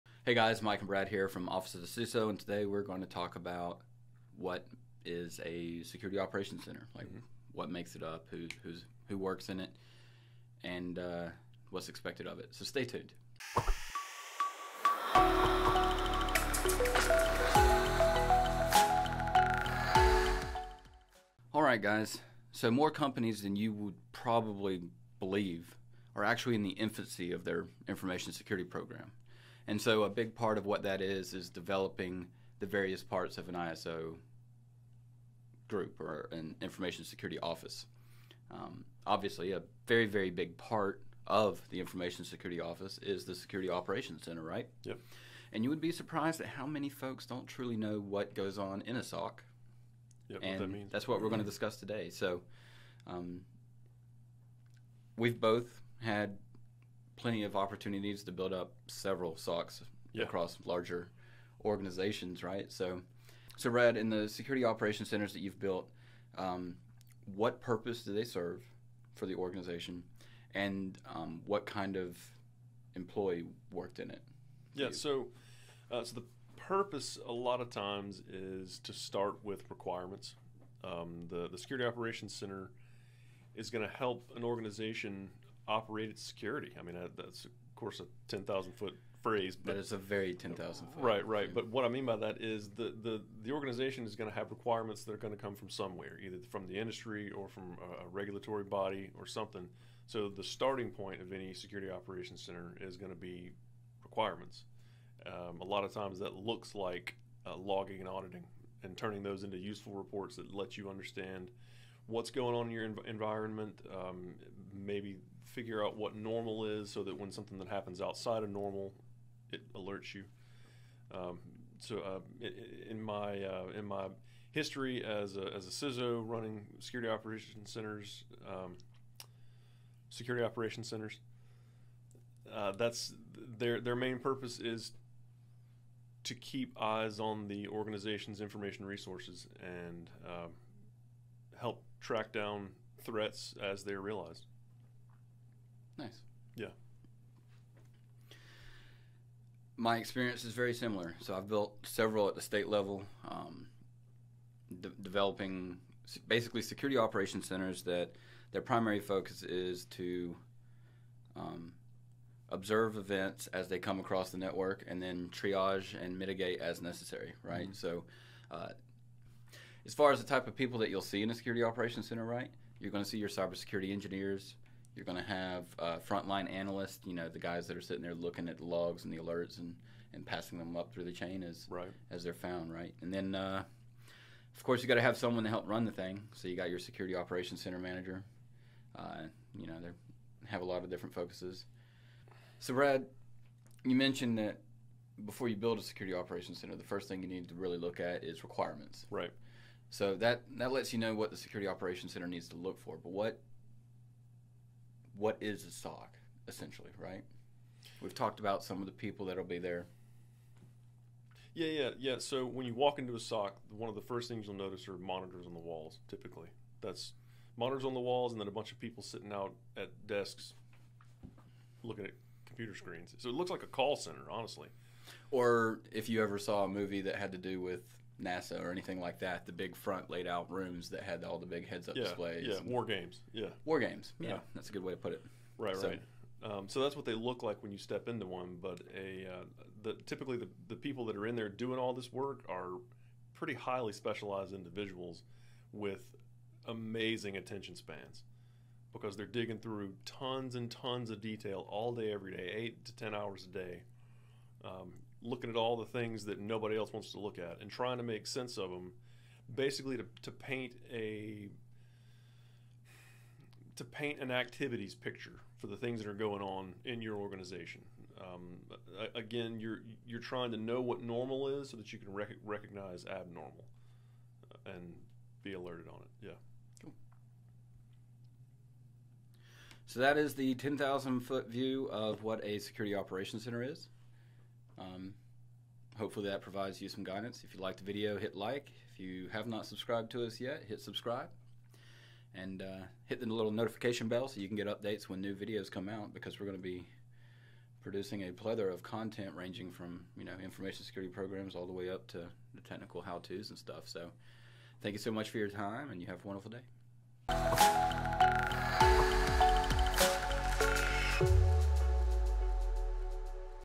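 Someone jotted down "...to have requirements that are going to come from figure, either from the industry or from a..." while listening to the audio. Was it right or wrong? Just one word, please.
wrong.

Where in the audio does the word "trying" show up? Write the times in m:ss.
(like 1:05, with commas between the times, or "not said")
4:17, 4:30.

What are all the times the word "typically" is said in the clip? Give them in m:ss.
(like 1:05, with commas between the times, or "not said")
3:36, 4:00.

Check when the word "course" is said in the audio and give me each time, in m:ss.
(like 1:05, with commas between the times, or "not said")
1:27, 3:04.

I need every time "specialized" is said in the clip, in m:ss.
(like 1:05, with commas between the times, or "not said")
4:03.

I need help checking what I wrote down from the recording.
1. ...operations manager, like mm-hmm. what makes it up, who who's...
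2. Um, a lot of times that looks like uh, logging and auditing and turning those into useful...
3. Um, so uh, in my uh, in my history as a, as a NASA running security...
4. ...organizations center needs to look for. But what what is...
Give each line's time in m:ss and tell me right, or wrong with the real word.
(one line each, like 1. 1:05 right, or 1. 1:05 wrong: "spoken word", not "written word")
1. 0:06 wrong: "center", not "manager"
2. 1:45 right
3. 2:01 wrong: "CISO", not "NASA"
4. 3:21 wrong: "operations", not "organizations".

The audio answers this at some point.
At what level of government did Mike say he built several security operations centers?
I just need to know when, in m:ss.
2:32.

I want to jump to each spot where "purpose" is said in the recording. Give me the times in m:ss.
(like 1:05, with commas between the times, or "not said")
1:07, 1:16, 2:14.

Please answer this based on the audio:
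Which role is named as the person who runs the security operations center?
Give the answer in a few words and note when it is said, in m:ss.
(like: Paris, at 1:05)
Security operations center manager, at 3:06.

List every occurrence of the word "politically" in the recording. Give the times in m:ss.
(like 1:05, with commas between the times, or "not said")
not said.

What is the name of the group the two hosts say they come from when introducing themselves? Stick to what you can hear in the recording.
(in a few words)
Office of the CISO.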